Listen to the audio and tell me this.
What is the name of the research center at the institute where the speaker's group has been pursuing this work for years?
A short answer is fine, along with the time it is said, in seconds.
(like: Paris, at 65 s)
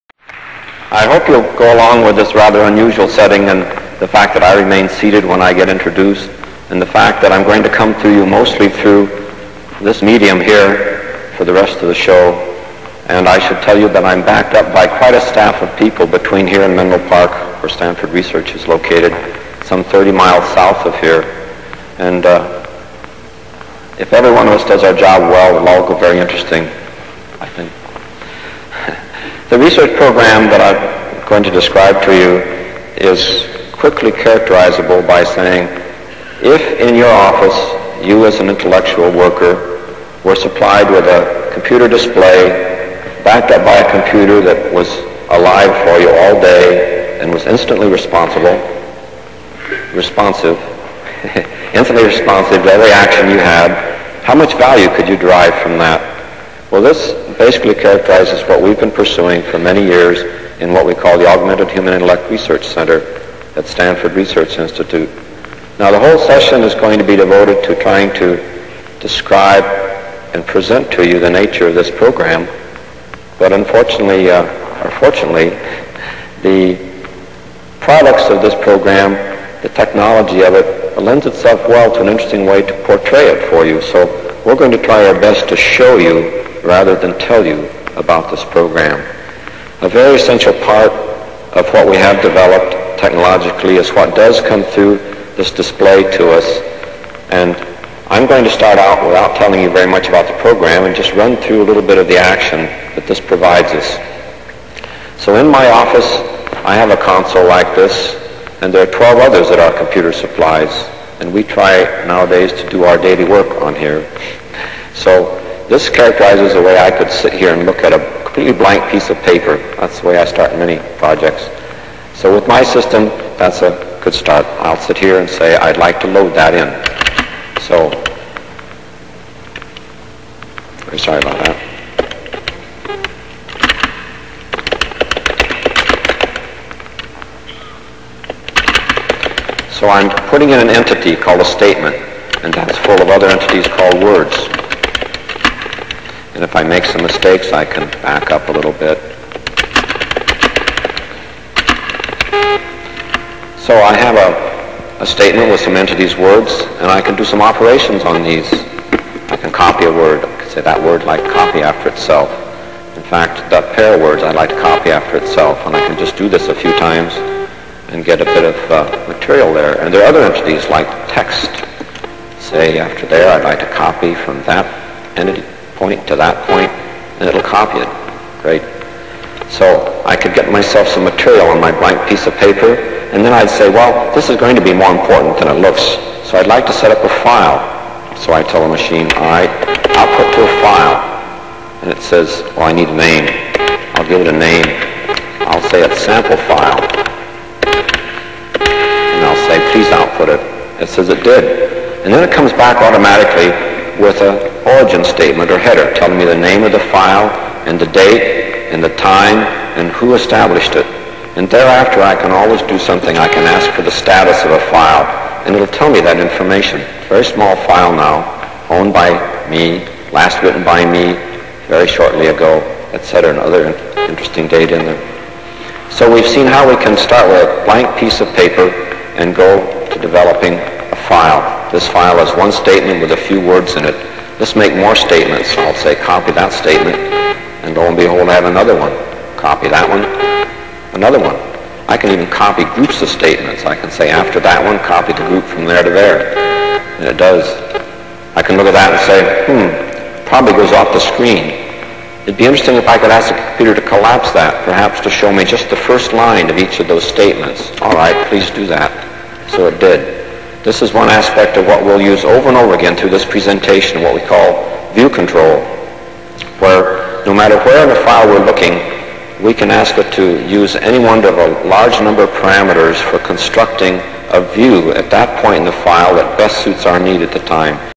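Augmented Human Intellect Research Center, at 61 s.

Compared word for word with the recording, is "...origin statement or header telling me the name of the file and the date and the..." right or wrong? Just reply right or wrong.
right.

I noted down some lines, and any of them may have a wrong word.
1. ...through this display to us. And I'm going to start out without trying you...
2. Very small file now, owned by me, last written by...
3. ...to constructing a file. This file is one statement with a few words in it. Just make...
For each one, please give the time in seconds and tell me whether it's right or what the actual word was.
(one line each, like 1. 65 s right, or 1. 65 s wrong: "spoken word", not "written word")
1. 94 s wrong: "telling", not "trying"
2. 217 s right
3. 229 s wrong: "developing", not "constructing".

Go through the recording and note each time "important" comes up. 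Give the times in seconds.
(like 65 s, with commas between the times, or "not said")
184 s.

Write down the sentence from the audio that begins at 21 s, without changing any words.
And uh, if every one of us does our job well, it'll all go very interesting, I think.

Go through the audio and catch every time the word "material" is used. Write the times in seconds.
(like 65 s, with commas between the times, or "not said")
169 s, 181 s.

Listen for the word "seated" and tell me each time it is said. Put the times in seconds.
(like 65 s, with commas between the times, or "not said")
4 s.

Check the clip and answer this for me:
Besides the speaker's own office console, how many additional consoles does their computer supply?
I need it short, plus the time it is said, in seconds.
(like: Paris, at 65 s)
12, at 108 s.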